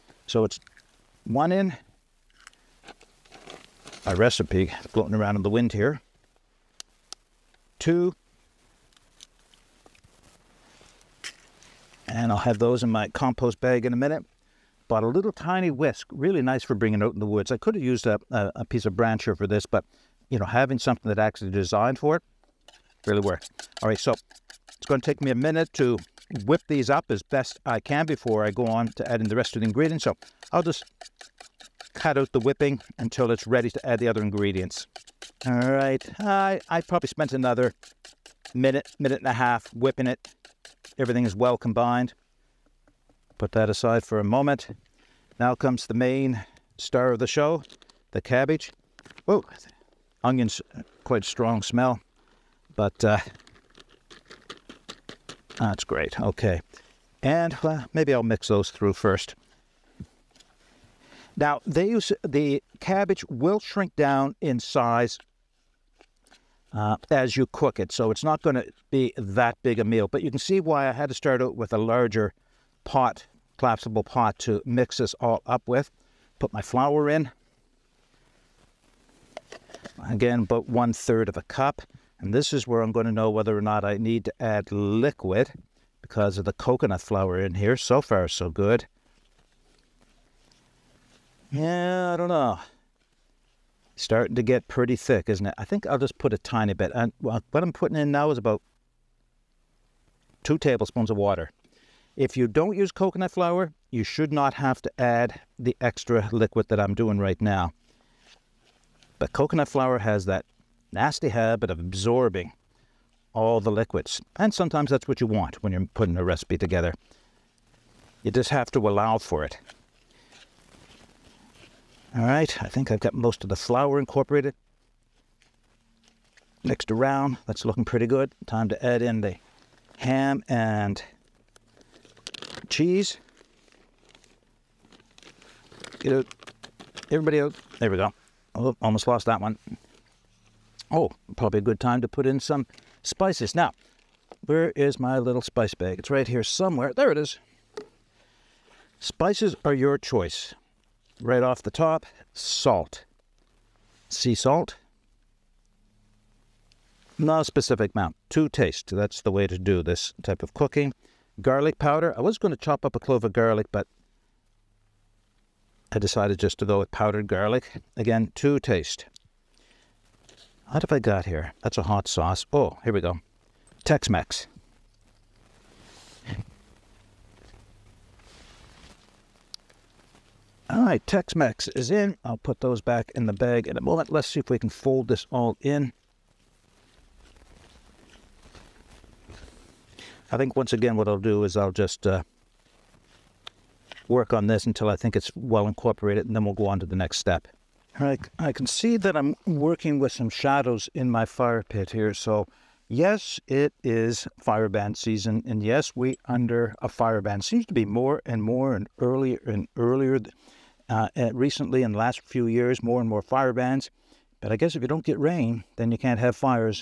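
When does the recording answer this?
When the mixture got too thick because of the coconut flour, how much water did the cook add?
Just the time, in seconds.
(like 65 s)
100 s.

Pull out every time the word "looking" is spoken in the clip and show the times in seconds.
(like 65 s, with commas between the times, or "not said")
127 s.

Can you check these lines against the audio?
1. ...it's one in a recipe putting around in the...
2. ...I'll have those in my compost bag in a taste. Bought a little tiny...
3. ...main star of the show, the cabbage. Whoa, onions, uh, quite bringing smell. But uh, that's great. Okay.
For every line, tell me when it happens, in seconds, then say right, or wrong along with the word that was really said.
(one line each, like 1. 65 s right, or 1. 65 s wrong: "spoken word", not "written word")
1. 0 s wrong: "floating", not "putting"
2. 12 s wrong: "minute", not "taste"
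3. 45 s wrong: "strong", not "bringing".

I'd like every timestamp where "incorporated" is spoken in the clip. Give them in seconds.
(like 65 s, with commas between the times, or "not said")
123 s, 195 s.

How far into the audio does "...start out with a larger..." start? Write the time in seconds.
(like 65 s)
71 s.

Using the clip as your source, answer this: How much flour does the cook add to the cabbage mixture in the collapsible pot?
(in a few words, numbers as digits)
1/3 cup.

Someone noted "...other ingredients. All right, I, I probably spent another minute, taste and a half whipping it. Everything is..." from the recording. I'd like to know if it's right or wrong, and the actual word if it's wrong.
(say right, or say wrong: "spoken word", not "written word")
wrong: "minute", not "taste".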